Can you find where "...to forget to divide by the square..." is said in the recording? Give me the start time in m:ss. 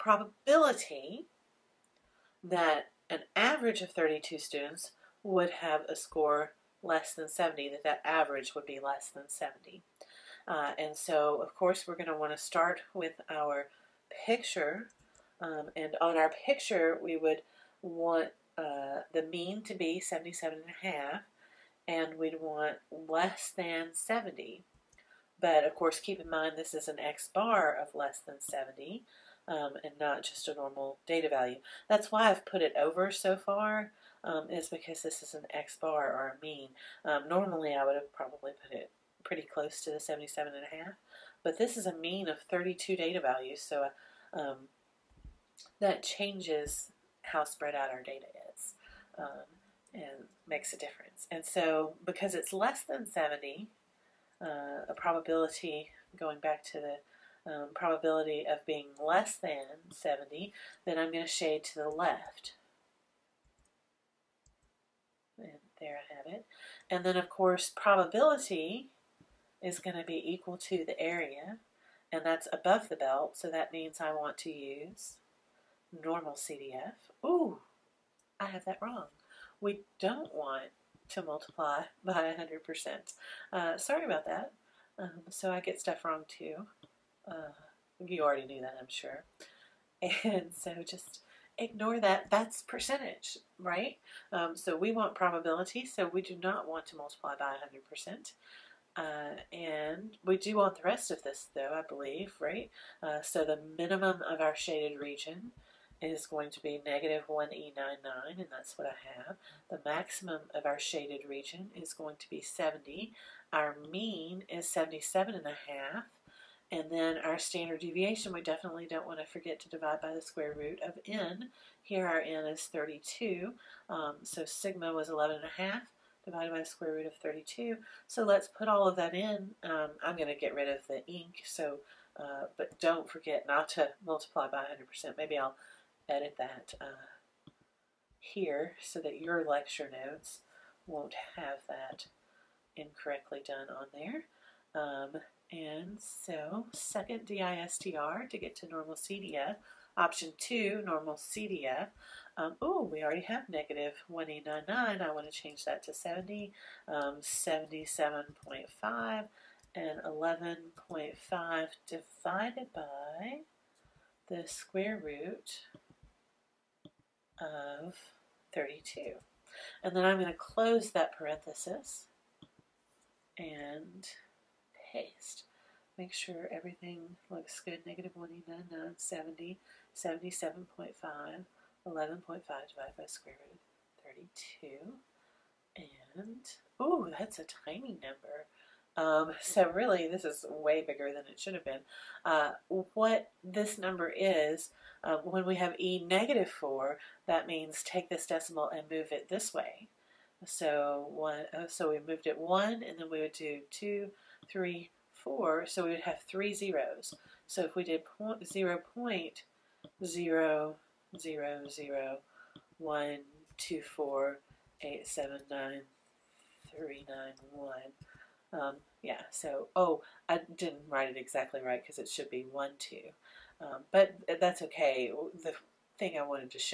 1:59.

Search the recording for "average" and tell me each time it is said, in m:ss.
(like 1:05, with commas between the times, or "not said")
0:03, 0:08.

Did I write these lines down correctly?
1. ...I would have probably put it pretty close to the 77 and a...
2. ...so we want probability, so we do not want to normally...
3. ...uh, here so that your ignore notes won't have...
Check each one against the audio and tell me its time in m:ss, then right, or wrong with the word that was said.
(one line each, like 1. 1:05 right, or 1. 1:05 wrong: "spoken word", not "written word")
1. 0:37 right
2. 1:34 wrong: "multiply", not "normally"
3. 2:16 wrong: "lecture", not "ignore".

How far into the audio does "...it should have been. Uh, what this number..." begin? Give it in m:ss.
3:11.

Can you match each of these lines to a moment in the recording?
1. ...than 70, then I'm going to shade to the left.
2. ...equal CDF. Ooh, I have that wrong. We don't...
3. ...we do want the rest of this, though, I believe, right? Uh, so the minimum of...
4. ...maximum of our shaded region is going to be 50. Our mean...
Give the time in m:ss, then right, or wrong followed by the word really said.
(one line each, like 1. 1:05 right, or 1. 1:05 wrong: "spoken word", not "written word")
1. 0:59 right
2. 1:16 wrong: "normal", not "equal"
3. 1:40 right
4. 1:49 wrong: "70", not "50".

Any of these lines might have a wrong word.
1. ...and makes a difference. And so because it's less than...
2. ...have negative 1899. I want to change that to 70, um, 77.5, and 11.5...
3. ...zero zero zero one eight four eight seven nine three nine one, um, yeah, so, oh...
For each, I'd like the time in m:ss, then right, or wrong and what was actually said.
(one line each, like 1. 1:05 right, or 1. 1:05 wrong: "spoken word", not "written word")
1. 0:49 right
2. 2:33 right
3. 3:30 wrong: "two", not "eight".